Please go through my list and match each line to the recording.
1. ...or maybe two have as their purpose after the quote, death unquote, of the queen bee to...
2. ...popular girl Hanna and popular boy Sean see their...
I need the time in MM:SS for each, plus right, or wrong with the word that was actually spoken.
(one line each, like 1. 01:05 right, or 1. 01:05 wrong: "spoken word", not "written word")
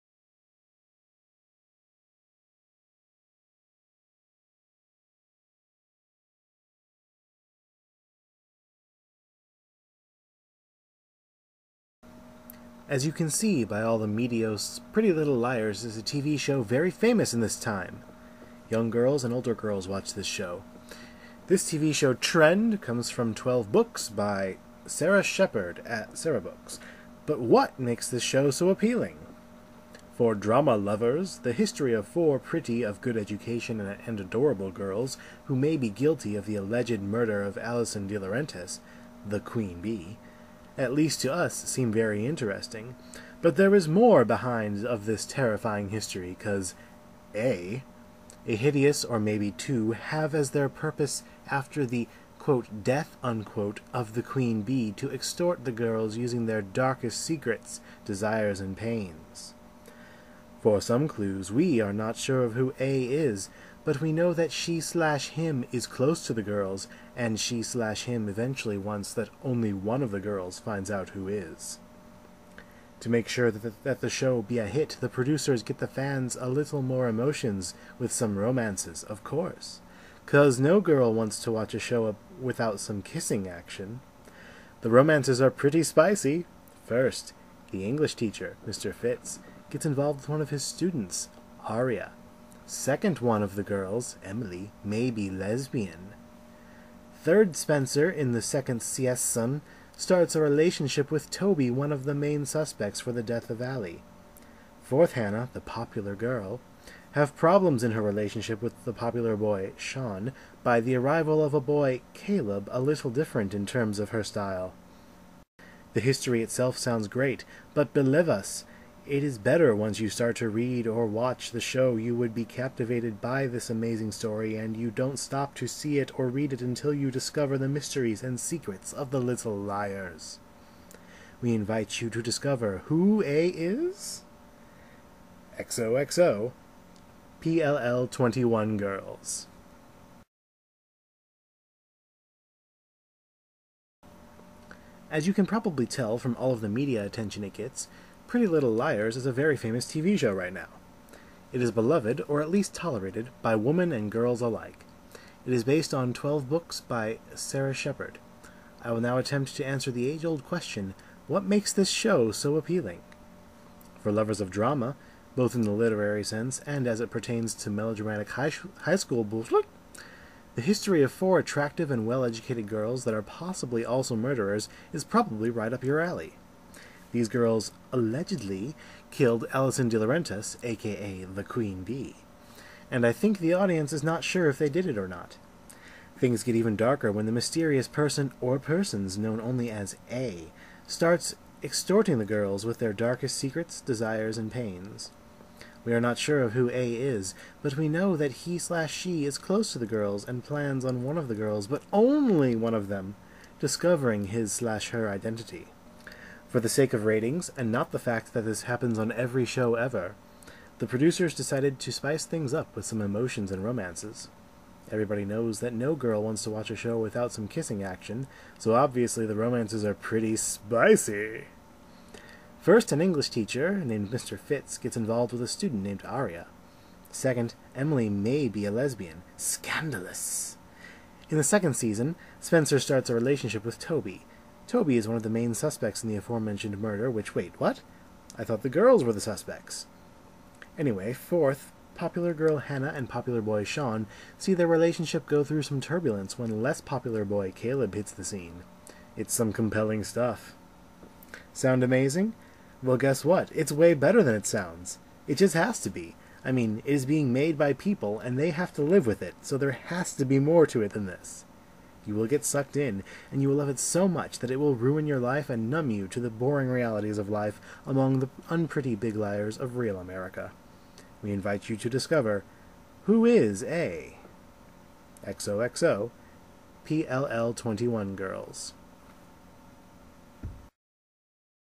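1. 00:49 right
2. 04:01 right.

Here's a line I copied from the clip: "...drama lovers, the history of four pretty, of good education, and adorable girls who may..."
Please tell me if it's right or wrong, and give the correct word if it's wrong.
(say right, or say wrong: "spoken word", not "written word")
right.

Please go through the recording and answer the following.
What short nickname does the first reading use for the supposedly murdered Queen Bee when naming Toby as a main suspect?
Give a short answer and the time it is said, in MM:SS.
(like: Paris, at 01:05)
Allie, at 01:43.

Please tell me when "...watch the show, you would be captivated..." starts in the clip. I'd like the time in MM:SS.
02:01.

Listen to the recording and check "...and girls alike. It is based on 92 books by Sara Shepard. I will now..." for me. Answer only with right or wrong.
wrong.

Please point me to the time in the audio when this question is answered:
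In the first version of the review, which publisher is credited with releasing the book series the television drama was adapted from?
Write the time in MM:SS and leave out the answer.
00:26.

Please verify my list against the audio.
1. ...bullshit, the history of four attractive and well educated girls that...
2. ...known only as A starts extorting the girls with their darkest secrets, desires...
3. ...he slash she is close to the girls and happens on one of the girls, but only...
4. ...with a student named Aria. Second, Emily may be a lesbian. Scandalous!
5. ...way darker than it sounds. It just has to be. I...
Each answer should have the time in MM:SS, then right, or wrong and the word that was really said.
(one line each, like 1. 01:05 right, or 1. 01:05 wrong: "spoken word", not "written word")
1. 02:49 right
2. 03:09 right
3. 03:18 wrong: "plans", not "happens"
4. 03:45 right
5. 04:13 wrong: "better", not "darker".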